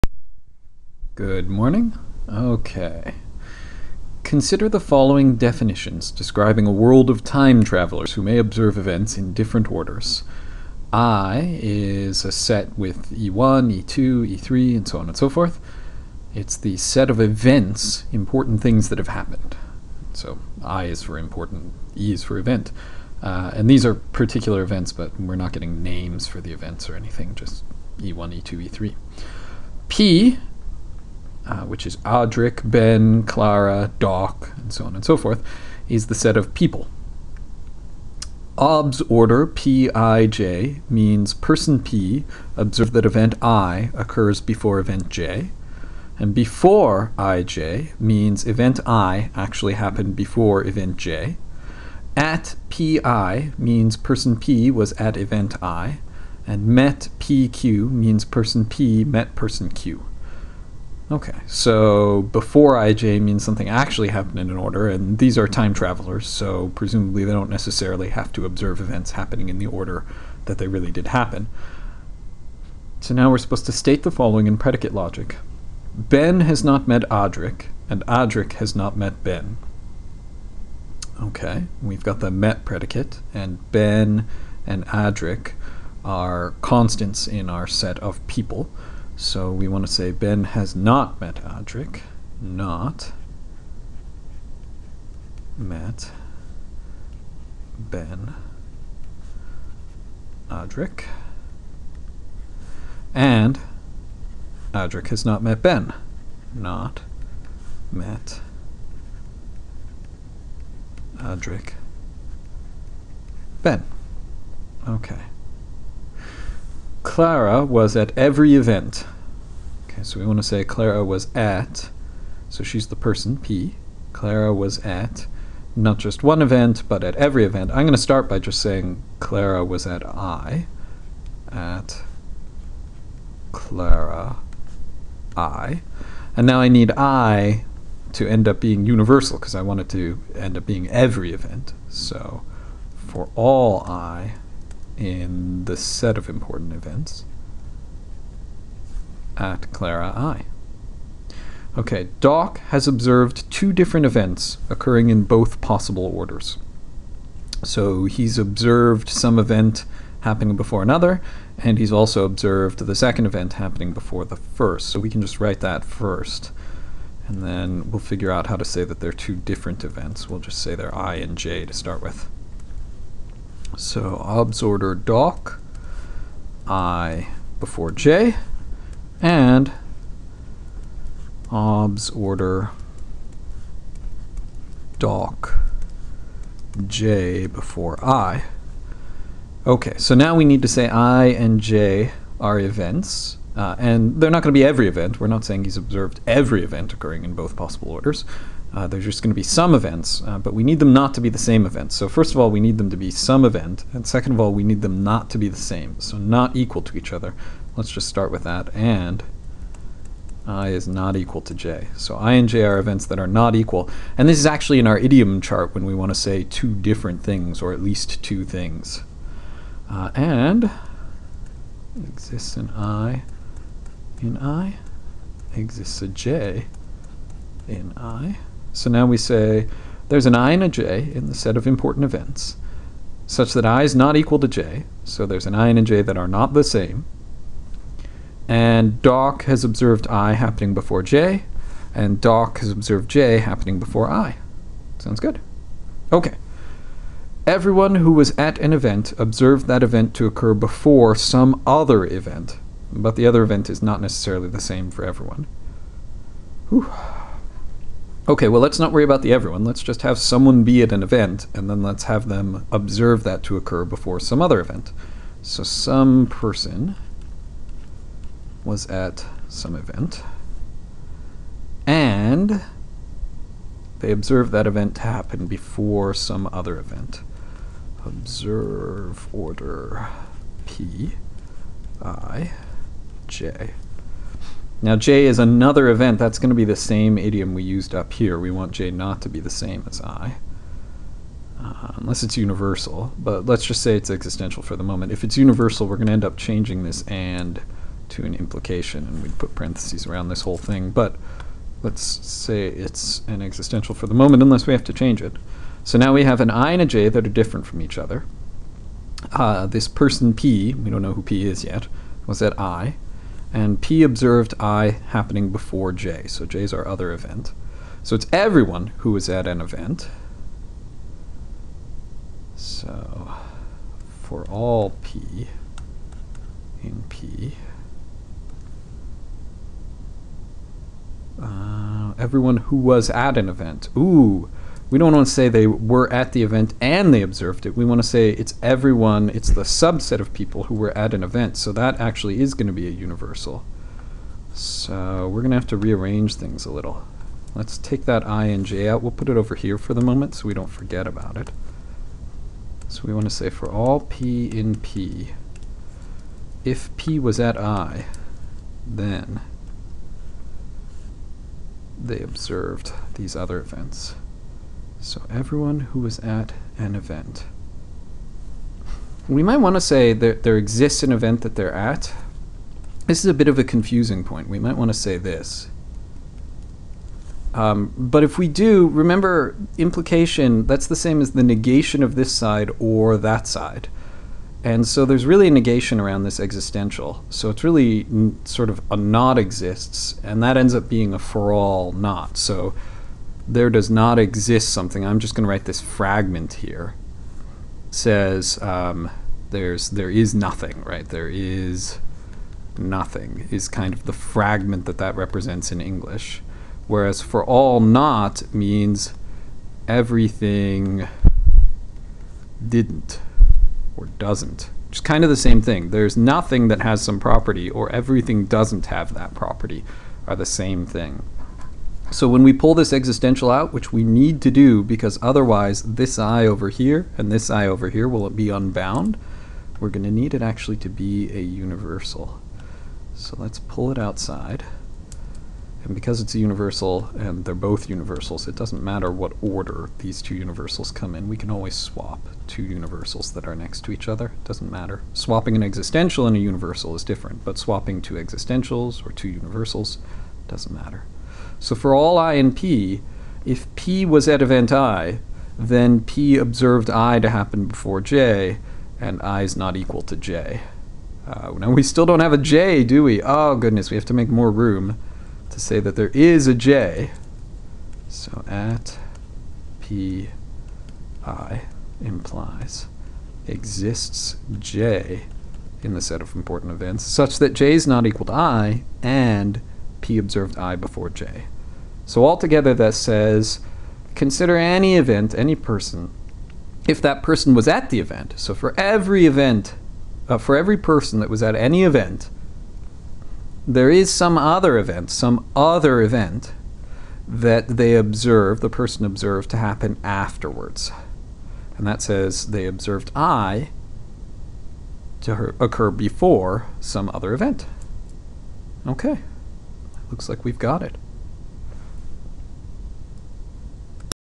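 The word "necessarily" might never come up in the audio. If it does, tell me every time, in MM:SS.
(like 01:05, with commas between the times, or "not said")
01:07, 04:14.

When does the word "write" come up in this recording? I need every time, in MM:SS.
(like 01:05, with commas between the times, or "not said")
02:45, 06:35.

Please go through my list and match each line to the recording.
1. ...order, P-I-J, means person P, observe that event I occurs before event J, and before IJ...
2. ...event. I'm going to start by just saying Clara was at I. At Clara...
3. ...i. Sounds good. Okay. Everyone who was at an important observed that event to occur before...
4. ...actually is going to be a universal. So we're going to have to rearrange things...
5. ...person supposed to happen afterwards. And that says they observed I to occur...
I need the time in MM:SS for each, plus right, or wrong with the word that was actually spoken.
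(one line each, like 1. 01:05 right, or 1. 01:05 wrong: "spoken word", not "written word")
1. 00:39 right
2. 02:07 right
3. 04:04 wrong: "event", not "important"
4. 05:42 right
5. 08:18 wrong: "observed", not "supposed".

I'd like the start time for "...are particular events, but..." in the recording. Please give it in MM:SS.
00:23.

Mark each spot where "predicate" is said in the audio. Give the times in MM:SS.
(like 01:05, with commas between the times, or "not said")
01:14, 01:22.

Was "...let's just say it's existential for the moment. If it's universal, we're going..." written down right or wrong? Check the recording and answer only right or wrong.
right.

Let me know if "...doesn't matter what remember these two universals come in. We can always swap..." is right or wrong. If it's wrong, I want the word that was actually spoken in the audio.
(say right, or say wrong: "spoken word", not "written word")
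wrong: "order", not "remember".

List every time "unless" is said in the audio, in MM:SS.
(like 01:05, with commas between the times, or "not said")
04:51, 05:04.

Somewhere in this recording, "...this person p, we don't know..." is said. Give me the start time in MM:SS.
05:09.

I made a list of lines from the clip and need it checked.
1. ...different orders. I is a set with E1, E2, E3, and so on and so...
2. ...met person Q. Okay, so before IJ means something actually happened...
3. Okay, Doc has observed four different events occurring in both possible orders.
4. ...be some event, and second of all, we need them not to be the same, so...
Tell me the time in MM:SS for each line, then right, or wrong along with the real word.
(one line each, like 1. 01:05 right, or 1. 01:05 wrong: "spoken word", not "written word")
1. 00:09 right
2. 00:59 right
3. 02:31 wrong: "two", not "four"
4. 03:22 right.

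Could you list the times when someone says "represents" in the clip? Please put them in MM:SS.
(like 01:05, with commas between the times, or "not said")
06:45.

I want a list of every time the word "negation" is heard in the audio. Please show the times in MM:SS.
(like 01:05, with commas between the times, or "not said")
06:21, 06:25.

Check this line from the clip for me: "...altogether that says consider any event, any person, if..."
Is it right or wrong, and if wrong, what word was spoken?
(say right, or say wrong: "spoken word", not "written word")
right.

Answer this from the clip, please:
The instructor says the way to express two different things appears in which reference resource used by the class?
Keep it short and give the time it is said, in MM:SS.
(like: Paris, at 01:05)
idiom chart, at 03:34.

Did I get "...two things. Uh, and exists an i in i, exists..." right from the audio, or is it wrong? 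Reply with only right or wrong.
right.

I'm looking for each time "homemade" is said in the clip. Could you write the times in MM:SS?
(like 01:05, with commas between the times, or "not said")
not said.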